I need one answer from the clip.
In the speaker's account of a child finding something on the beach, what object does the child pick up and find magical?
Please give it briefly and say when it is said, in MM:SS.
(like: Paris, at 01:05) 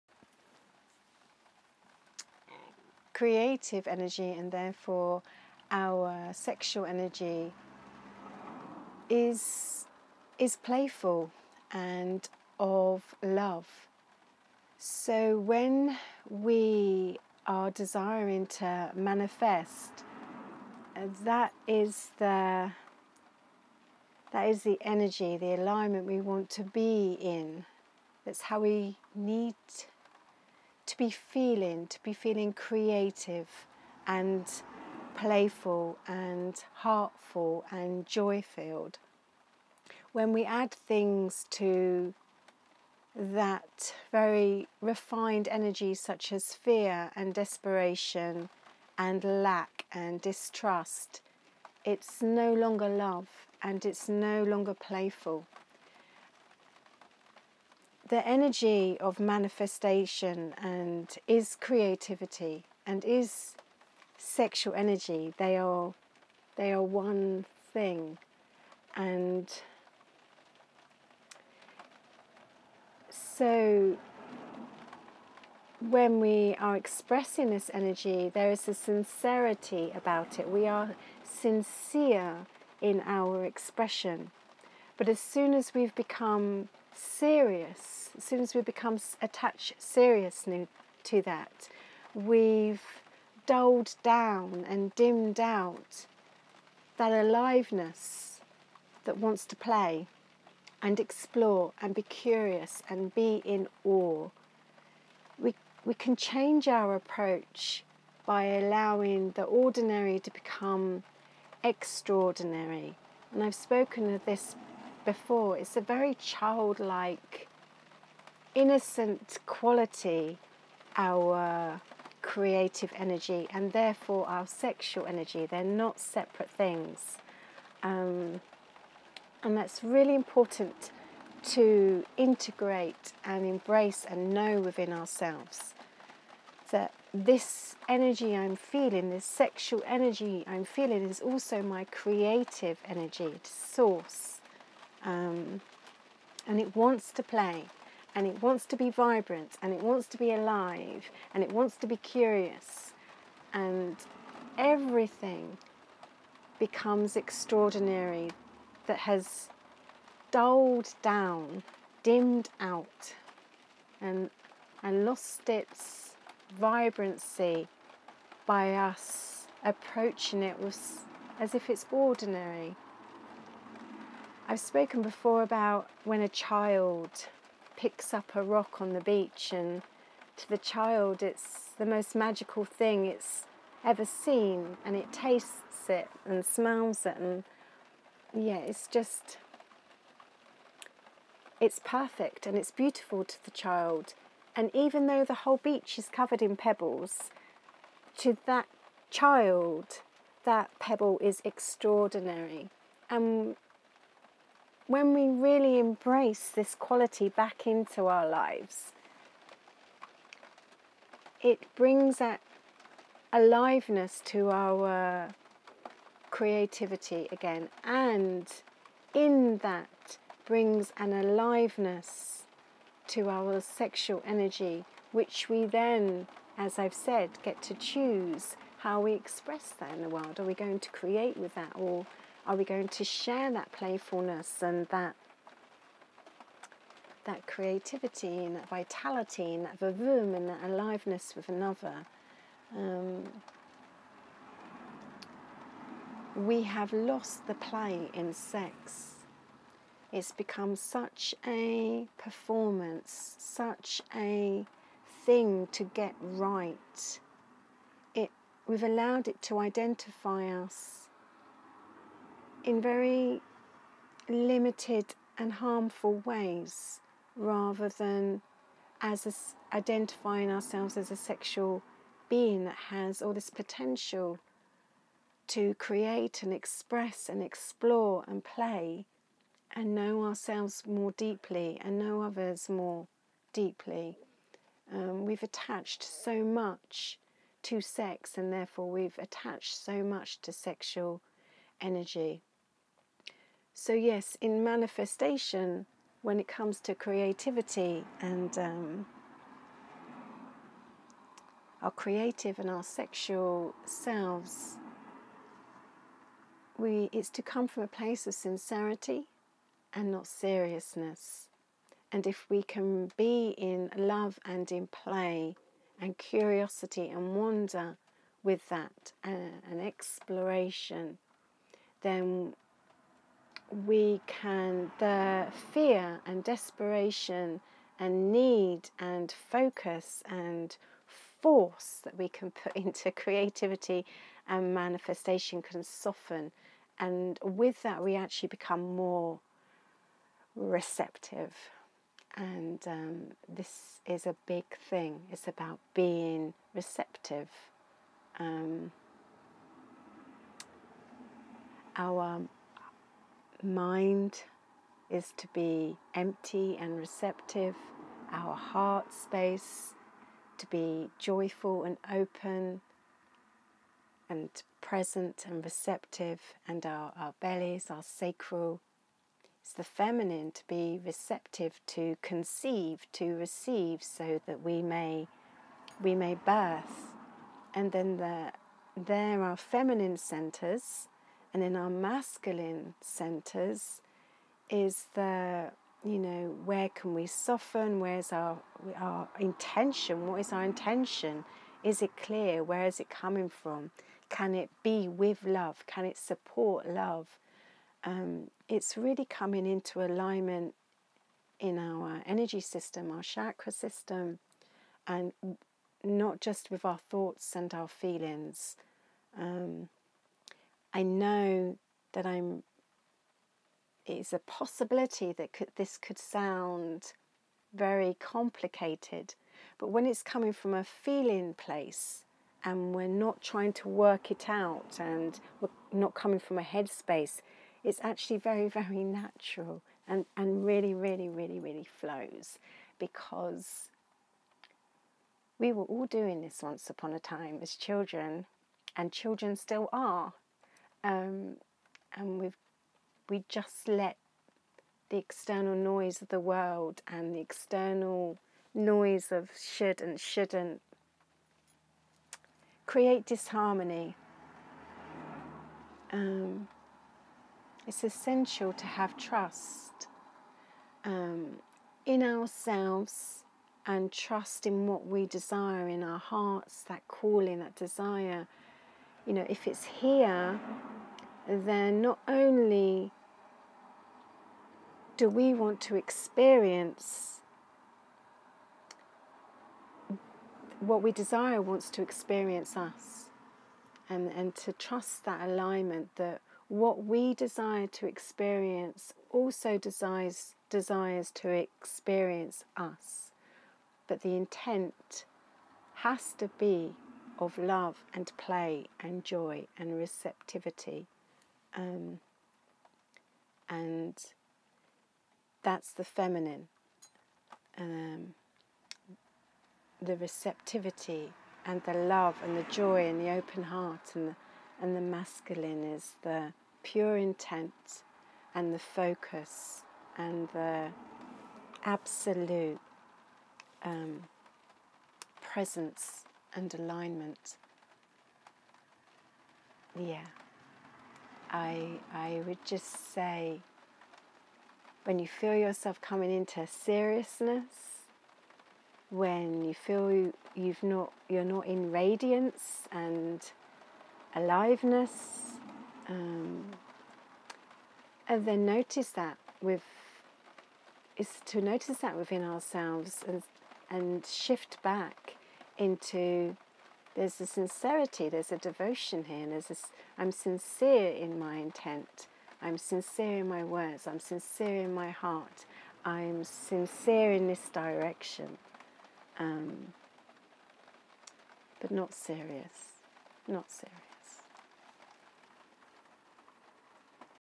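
a rock, at 02:58.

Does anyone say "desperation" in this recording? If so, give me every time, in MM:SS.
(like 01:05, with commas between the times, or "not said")
00:47, 05:26.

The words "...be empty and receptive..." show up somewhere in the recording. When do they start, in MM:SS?
05:55.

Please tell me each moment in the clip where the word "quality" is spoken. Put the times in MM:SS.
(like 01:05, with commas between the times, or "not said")
01:59, 03:26.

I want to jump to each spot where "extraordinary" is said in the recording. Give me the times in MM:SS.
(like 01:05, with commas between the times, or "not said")
01:51, 02:37, 03:21.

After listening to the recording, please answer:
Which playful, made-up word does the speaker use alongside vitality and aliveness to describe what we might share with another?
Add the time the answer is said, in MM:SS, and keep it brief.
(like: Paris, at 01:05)
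vavoom, at 03:59.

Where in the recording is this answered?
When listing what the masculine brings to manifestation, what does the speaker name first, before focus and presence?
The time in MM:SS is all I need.
08:36.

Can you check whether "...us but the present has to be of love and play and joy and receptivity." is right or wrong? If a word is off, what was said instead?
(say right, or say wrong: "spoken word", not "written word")
wrong: "intent", not "present".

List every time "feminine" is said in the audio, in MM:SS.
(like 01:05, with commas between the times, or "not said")
06:09, 06:19, 08:26.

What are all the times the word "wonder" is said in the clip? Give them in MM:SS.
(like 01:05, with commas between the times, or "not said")
05:17.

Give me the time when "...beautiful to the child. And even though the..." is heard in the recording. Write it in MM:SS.
03:12.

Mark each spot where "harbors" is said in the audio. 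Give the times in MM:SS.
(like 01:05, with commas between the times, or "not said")
not said.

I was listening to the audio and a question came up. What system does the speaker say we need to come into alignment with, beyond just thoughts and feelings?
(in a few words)
chakra system.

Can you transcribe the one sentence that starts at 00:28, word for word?
That's how we need to be feeling, to be feeling creative and playful and heartful and joy filled.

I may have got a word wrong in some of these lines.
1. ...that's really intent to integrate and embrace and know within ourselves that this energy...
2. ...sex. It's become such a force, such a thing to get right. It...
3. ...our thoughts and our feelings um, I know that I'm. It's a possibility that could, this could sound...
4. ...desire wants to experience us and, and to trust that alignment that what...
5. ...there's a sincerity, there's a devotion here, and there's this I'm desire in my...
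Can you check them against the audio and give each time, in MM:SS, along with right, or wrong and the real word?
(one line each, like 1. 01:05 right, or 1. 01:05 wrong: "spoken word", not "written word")
1. 02:09 wrong: "important", not "intent"
2. 04:08 wrong: "performance", not "force"
3. 06:46 right
4. 08:01 right
5. 09:17 wrong: "sincere", not "desire".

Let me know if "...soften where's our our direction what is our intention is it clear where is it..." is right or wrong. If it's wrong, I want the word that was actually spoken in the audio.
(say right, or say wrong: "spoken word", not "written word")
wrong: "intention", not "direction".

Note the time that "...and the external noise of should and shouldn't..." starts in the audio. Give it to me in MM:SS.
07:27.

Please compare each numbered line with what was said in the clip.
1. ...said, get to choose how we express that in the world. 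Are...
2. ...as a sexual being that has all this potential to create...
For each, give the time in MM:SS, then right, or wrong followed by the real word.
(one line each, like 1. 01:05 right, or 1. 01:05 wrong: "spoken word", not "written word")
1. 03:46 right
2. 04:30 right.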